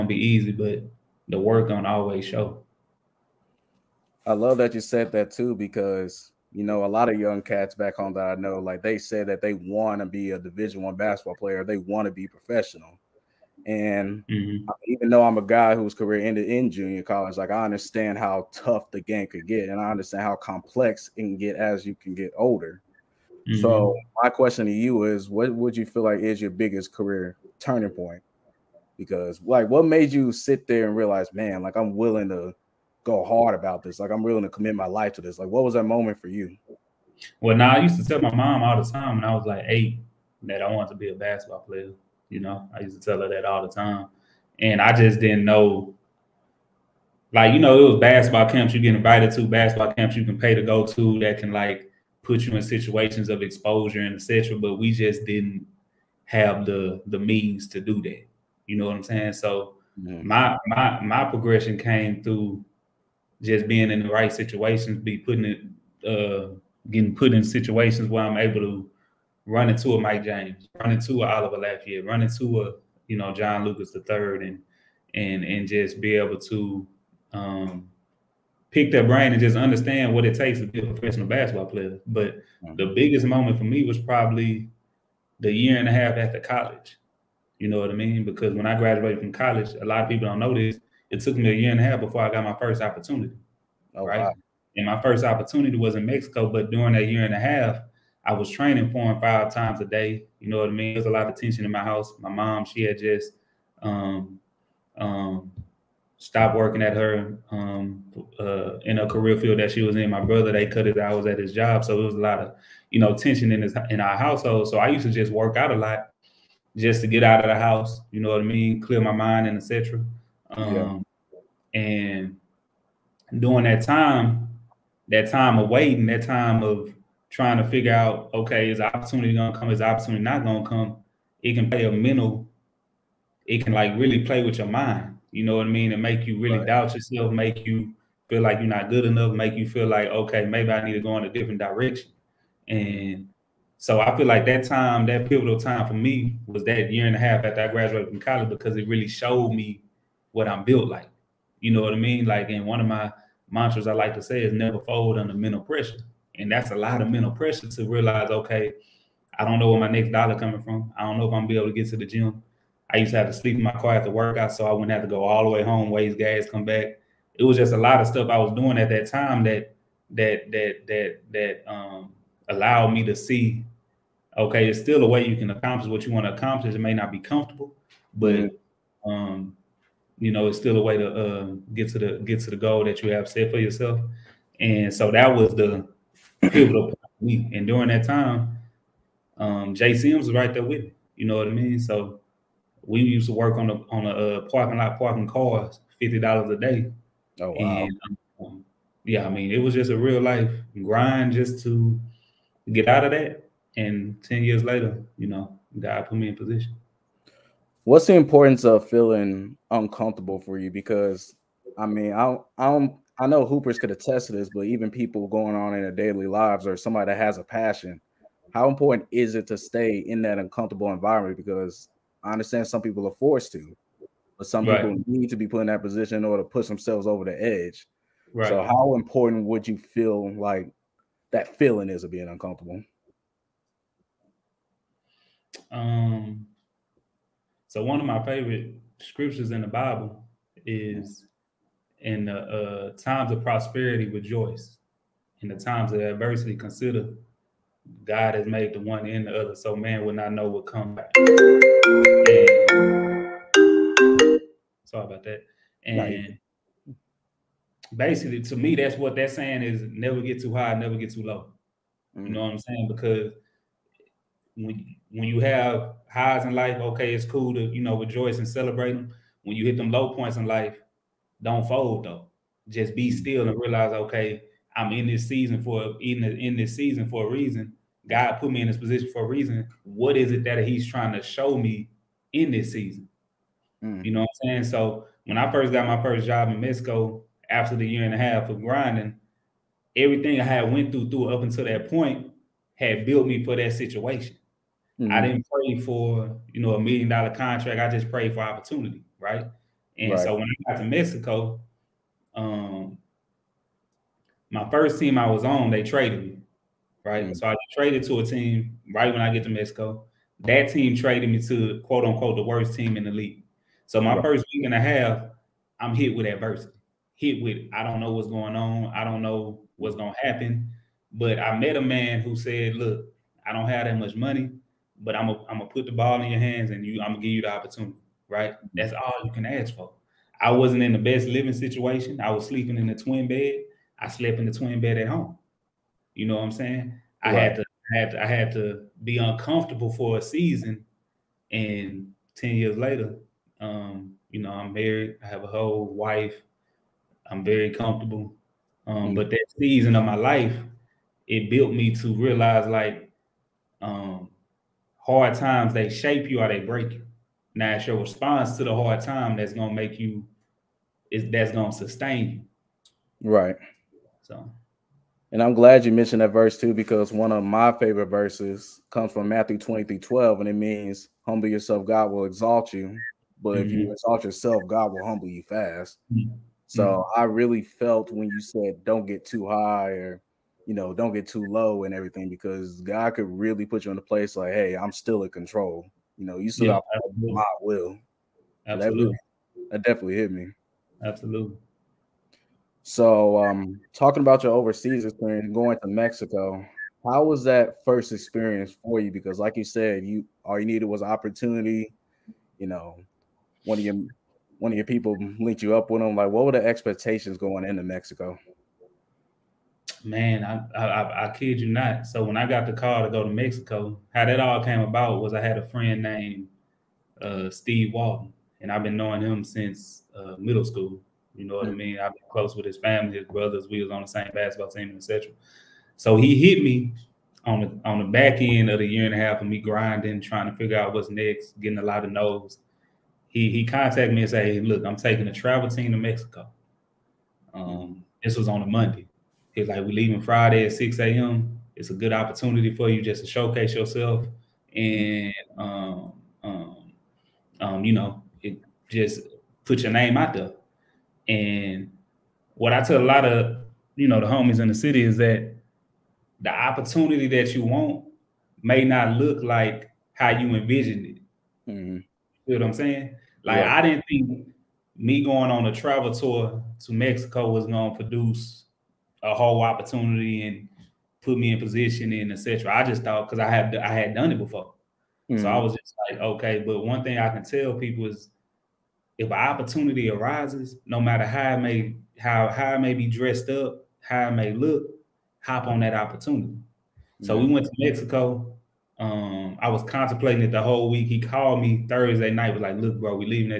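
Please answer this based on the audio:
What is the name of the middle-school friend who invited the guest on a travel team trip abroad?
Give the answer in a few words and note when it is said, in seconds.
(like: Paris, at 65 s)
Steve Walton, at 417 s.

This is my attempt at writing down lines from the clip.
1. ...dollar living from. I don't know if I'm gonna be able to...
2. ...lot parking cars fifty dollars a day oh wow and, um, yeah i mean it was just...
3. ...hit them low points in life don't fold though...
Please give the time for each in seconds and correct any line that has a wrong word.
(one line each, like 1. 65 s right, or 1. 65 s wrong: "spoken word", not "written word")
1. 160 s wrong: "coming", not "living"
2. 194 s right
3. 269 s right.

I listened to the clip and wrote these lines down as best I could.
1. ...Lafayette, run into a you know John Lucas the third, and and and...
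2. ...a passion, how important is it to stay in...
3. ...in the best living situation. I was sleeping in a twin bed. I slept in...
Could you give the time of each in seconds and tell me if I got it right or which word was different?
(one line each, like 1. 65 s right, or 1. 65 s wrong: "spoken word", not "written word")
1. 71 s right
2. 217 s right
3. 330 s right.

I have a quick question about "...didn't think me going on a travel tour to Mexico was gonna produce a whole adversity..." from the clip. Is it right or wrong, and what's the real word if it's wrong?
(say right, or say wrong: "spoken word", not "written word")
wrong: "opportunity", not "adversity".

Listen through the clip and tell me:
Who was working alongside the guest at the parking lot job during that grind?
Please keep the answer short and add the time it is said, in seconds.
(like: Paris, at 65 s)
Jay Sims, at 189 s.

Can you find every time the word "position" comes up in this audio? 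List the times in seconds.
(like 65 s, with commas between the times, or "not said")
206 s, 225 s, 278 s, 471 s.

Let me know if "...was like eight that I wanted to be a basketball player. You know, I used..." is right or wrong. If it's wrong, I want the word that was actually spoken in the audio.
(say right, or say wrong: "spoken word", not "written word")
right.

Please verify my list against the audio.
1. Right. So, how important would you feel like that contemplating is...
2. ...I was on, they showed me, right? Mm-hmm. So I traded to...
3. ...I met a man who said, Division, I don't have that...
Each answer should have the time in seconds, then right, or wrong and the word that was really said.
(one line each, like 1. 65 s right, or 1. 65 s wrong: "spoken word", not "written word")
1. 228 s wrong: "feeling", not "contemplating"
2. 305 s wrong: "traded", not "showed"
3. 321 s wrong: "Look", not "Division".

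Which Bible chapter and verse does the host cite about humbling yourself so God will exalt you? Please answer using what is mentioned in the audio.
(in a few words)
Matthew 23:12.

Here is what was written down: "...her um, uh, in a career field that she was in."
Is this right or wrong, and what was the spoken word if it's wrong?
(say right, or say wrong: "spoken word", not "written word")
right.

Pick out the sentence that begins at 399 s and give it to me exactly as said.
Because, like you said, you all you needed was opportunity.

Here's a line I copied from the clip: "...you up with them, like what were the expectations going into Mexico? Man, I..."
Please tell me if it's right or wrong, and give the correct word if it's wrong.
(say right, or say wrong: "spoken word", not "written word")
right.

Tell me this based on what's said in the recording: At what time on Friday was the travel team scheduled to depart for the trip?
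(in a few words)
6 a.m.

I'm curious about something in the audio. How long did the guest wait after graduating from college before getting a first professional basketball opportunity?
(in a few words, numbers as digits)
a year and a half.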